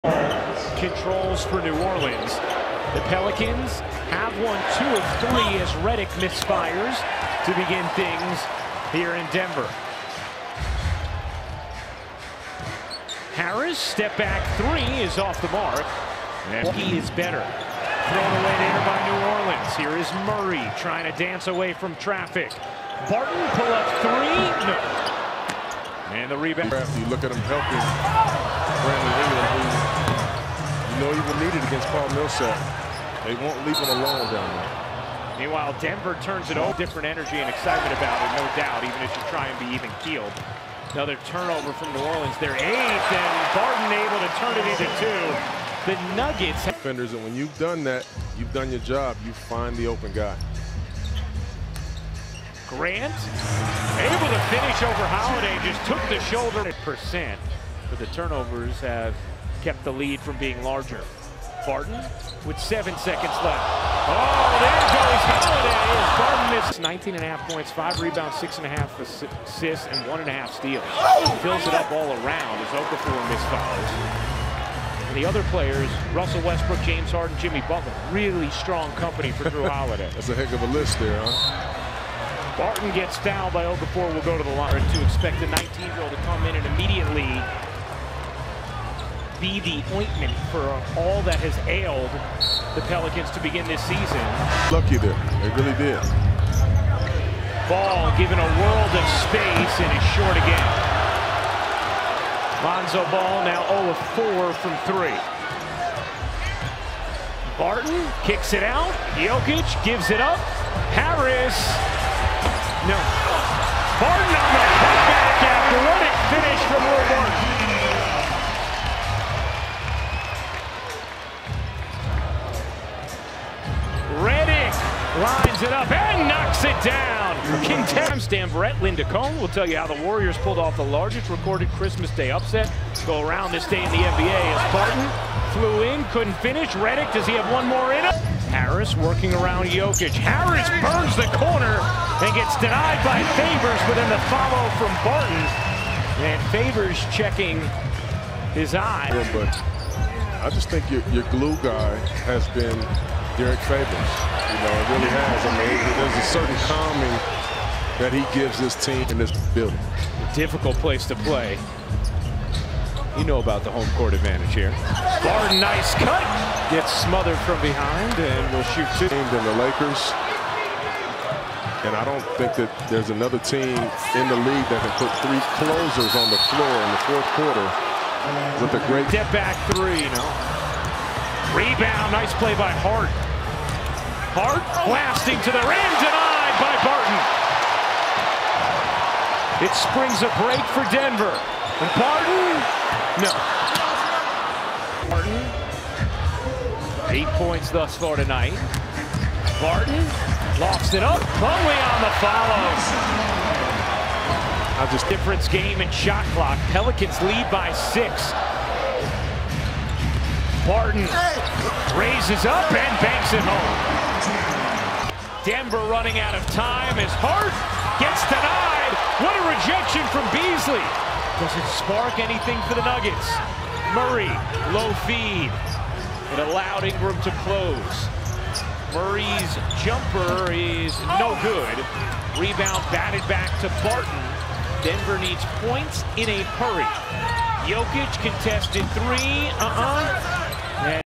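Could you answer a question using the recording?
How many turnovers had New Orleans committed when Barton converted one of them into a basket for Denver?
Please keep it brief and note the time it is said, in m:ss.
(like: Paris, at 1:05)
8, at 0:42.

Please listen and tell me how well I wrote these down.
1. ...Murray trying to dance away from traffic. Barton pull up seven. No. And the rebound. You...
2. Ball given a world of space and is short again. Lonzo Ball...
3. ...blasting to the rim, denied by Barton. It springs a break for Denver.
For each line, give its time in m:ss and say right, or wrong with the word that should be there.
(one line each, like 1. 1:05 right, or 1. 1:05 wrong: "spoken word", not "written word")
1. 0:20 wrong: "three", not "seven"
2. 1:37 right
3. 3:04 right.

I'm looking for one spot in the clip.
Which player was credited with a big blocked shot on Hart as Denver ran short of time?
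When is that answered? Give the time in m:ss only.
3:40.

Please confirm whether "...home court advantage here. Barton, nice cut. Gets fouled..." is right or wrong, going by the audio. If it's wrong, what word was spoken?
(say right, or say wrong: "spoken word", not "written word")
wrong: "smothered", not "fouled".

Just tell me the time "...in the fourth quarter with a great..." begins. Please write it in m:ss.
2:56.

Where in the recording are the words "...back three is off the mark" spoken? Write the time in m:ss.
0:14.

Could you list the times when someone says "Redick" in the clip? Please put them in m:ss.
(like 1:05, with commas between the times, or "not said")
0:05, 2:16.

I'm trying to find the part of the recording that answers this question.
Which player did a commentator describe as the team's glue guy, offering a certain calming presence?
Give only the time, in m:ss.
2:33.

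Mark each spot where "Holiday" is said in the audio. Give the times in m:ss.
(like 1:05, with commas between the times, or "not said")
0:55, 1:05, 1:19.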